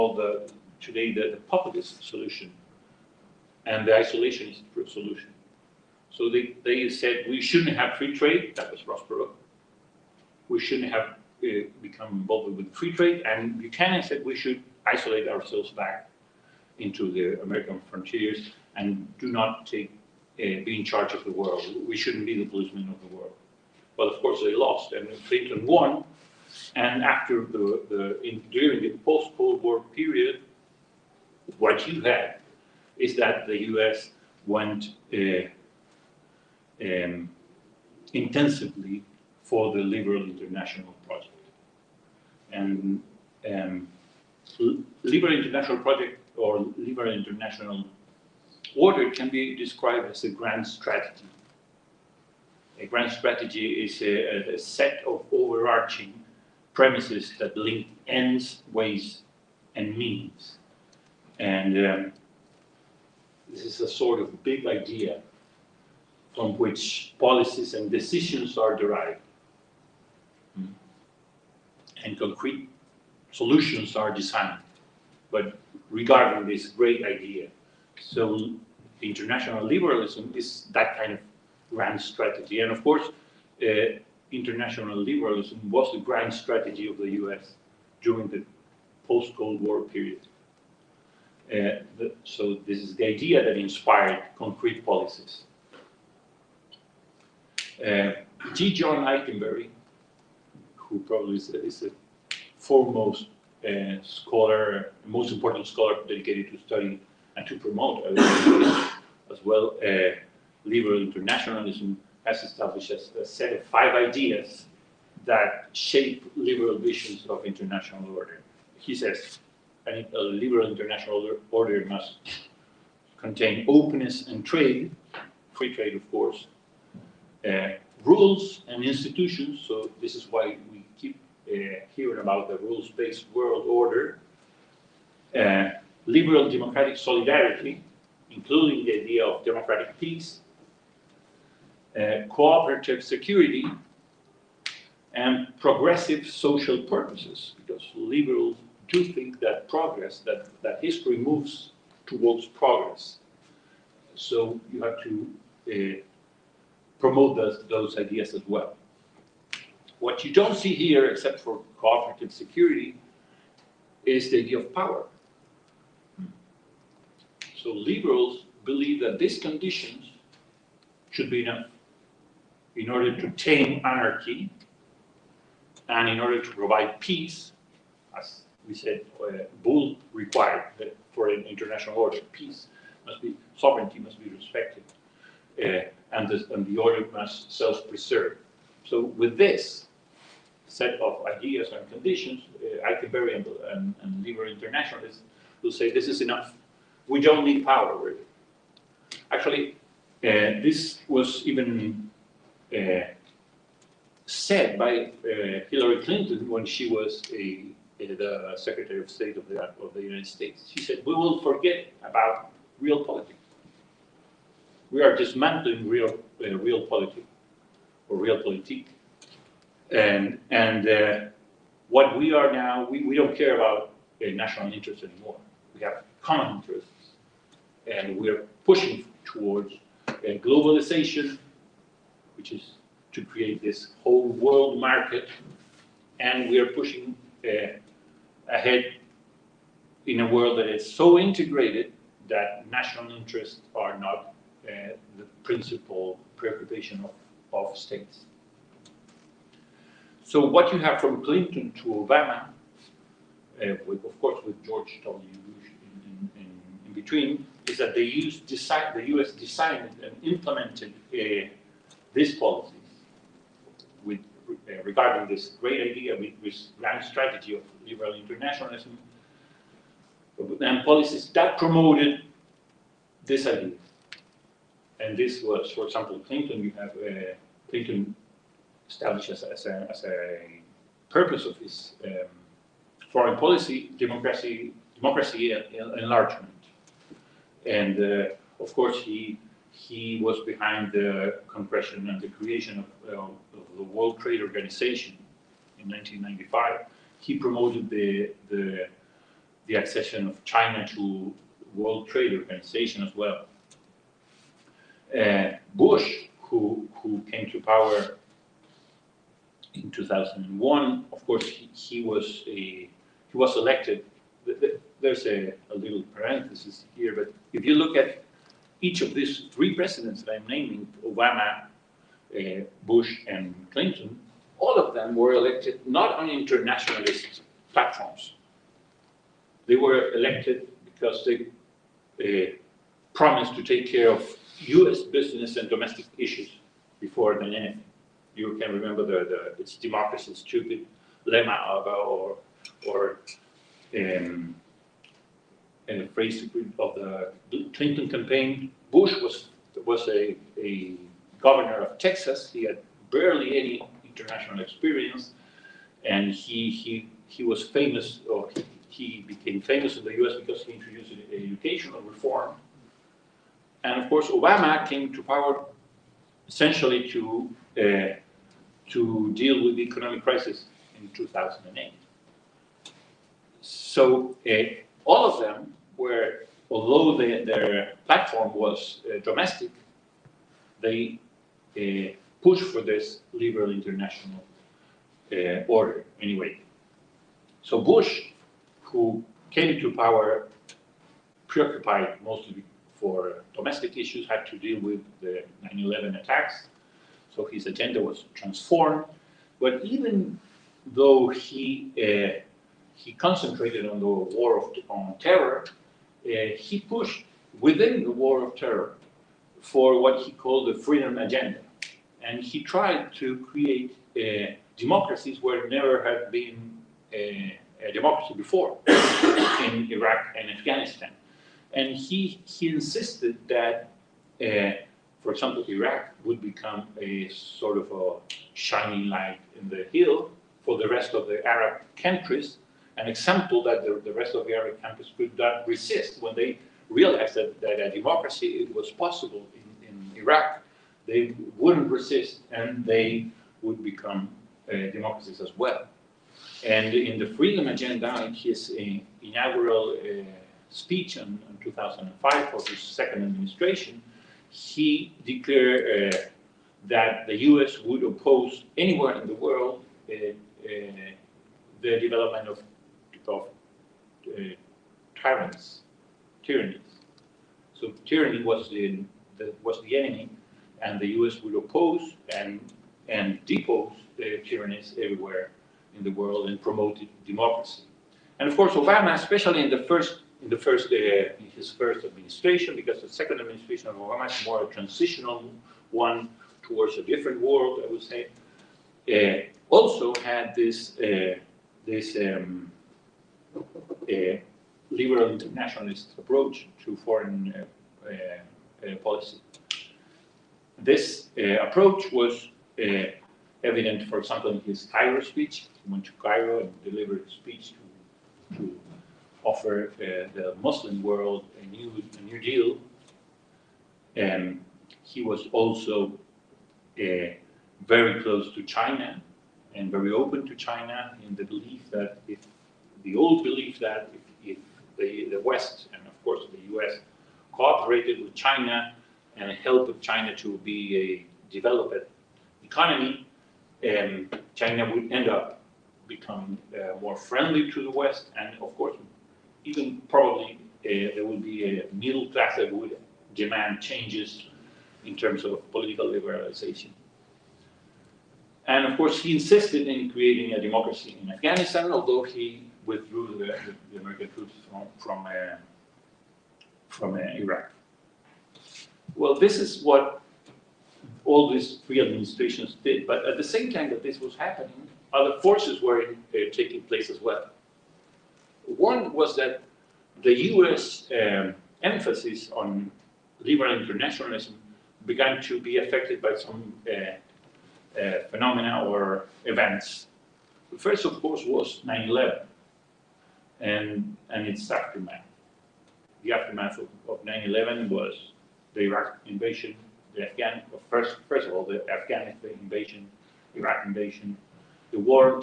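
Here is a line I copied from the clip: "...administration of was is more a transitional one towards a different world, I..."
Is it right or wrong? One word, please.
right.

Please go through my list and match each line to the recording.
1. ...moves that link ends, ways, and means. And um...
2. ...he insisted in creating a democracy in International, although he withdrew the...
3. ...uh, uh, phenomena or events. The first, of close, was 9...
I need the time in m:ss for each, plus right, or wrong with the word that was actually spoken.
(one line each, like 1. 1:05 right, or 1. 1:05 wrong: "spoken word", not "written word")
1. 0:56 wrong: "premises", not "moves"
2. 9:09 wrong: "Afghanistan", not "International"
3. 9:36 wrong: "course", not "close".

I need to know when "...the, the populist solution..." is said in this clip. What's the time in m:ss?
0:01.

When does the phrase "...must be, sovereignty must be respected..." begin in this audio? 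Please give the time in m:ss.
3:03.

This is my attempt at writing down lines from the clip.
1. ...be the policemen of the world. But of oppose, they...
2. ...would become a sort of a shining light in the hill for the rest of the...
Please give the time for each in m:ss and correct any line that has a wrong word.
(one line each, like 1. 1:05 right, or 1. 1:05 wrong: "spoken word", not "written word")
1. 0:22 wrong: "course", not "oppose"
2. 7:06 right.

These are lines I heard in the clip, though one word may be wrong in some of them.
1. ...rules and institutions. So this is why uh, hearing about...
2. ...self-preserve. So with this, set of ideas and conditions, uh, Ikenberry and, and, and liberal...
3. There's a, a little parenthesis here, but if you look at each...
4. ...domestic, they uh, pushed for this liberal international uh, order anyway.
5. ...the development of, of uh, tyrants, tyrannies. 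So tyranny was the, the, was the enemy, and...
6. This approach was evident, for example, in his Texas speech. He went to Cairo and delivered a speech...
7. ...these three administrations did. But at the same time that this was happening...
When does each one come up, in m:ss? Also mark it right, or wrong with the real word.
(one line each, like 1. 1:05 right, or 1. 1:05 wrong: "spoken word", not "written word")
1. 2:08 right
2. 3:07 right
3. 5:15 right
4. 6:19 right
5. 7:41 right
6. 8:20 wrong: "Cairo", not "Texas"
7. 9:21 right.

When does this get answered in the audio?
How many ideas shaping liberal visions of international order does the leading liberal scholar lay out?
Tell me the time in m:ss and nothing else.
1:53.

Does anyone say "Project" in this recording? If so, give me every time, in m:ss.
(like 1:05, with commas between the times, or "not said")
0:41, 0:45.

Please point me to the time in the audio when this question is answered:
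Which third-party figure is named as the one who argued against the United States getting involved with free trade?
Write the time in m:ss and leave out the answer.
0:08.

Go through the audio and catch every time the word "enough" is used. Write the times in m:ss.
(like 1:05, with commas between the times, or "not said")
2:51, 3:16.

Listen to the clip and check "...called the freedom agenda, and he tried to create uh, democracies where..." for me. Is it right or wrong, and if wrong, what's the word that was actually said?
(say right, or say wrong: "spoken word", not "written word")
right.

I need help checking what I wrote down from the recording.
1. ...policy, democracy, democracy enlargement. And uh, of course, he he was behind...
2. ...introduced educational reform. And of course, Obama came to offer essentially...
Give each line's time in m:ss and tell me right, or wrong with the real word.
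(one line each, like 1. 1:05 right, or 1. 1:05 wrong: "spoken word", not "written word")
1. 4:43 right
2. 6:00 wrong: "power", not "offer".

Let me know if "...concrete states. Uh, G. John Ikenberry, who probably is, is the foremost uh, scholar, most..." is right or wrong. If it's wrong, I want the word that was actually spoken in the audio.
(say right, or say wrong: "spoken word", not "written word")
wrong: "policies", not "states".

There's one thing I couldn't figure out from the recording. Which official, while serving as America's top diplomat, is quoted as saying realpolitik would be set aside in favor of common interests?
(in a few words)
Hillary Clinton.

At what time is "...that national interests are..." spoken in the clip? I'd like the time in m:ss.
4:02.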